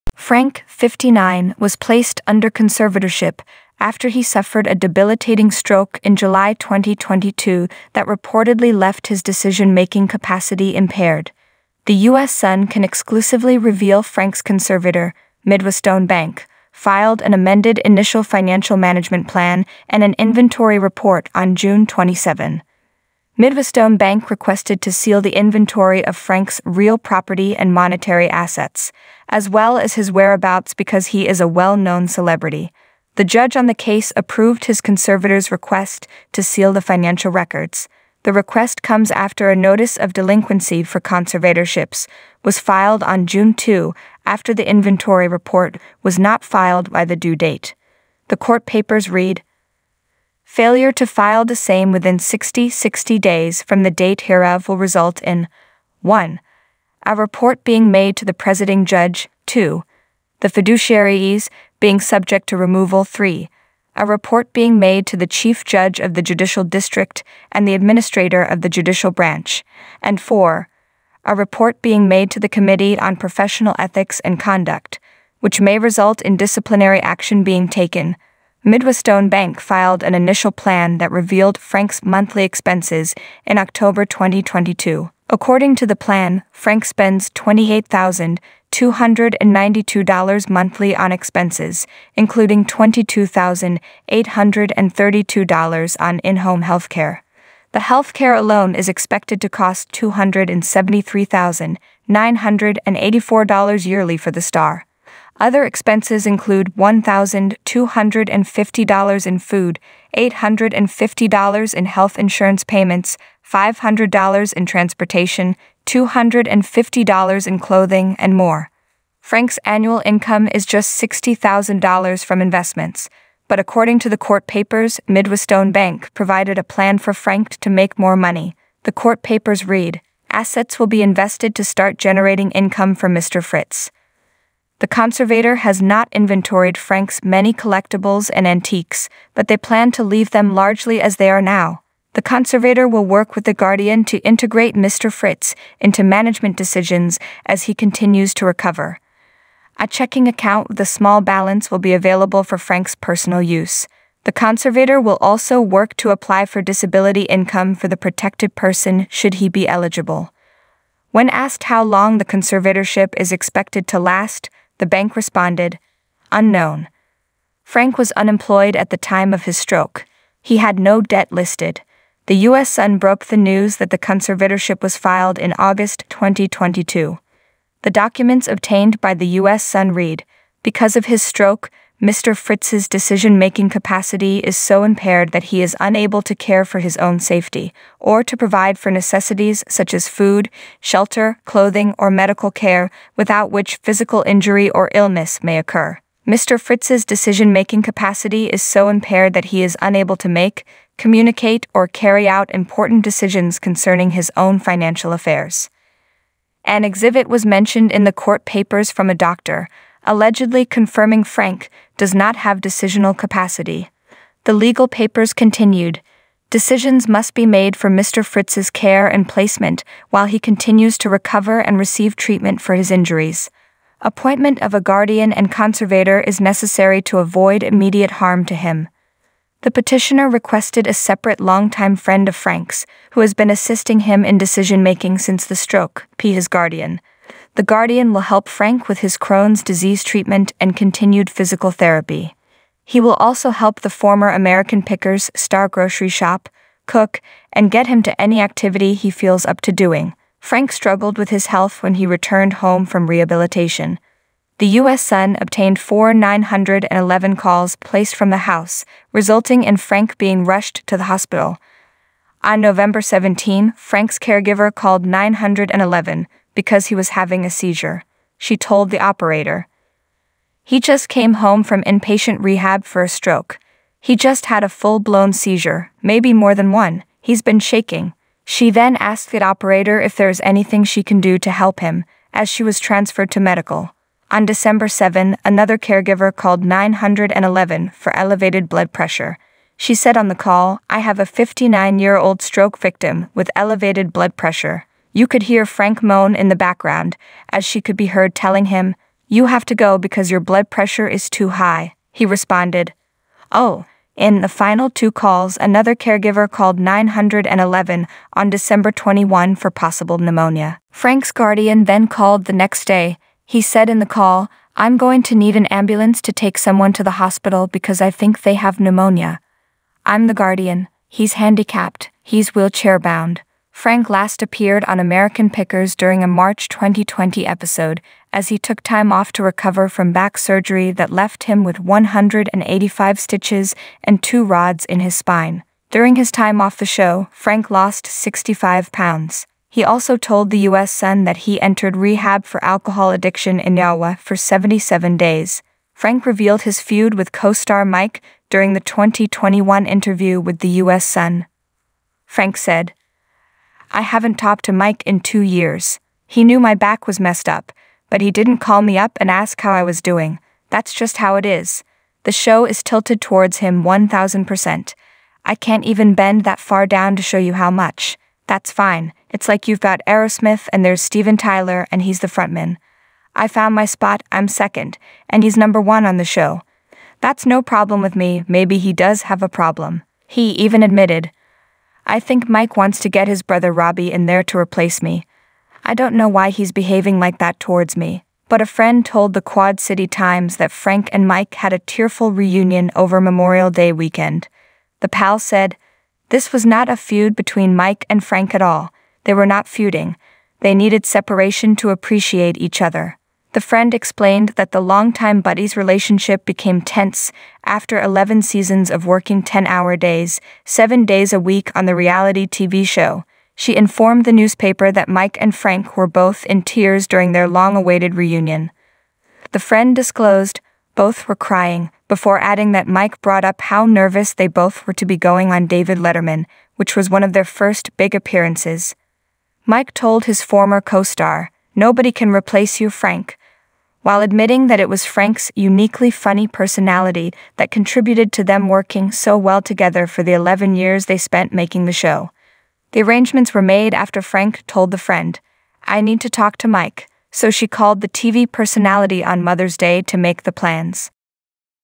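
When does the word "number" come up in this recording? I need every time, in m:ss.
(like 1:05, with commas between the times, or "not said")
6:15.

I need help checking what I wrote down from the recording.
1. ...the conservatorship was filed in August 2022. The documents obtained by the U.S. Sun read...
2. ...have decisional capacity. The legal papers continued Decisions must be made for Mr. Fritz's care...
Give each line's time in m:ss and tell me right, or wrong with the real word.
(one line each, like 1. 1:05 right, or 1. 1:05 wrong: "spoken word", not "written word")
1. 2:53 right
2. 3:32 right.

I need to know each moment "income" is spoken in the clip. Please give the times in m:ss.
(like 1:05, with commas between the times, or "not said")
2:00, 2:12, 2:37.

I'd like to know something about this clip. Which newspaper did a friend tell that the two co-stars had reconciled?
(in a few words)
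Quad City Times.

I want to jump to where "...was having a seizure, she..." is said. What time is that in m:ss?
4:26.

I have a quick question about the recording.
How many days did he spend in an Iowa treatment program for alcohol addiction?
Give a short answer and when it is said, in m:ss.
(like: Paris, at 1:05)
77, at 5:44.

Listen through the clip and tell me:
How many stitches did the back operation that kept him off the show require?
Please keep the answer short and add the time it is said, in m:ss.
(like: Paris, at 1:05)
185, at 5:31.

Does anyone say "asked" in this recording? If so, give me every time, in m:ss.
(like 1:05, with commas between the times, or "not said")
2:41, 4:38.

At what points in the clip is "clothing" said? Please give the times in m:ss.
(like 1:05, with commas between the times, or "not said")
1:57, 3:11.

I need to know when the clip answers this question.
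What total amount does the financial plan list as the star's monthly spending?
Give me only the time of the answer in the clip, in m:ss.
1:27.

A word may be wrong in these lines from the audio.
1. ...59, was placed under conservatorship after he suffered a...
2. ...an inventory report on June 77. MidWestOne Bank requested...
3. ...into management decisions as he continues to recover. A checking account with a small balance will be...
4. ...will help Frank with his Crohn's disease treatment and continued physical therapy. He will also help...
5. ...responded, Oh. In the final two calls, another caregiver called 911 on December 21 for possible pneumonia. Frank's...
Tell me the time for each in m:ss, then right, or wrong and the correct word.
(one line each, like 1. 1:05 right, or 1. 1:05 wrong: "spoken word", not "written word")
1. 0:00 right
2. 0:20 wrong: "27", not "77"
3. 2:25 right
4. 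3:58 right
5. 5:02 right.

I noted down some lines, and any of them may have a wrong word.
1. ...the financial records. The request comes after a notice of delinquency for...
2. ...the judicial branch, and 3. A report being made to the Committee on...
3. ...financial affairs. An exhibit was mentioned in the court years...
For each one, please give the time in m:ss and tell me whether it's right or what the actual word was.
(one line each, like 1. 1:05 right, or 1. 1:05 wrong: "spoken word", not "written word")
1. 0:36 right
2. 1:08 wrong: "4", not "3"
3. 3:24 wrong: "papers", not "years".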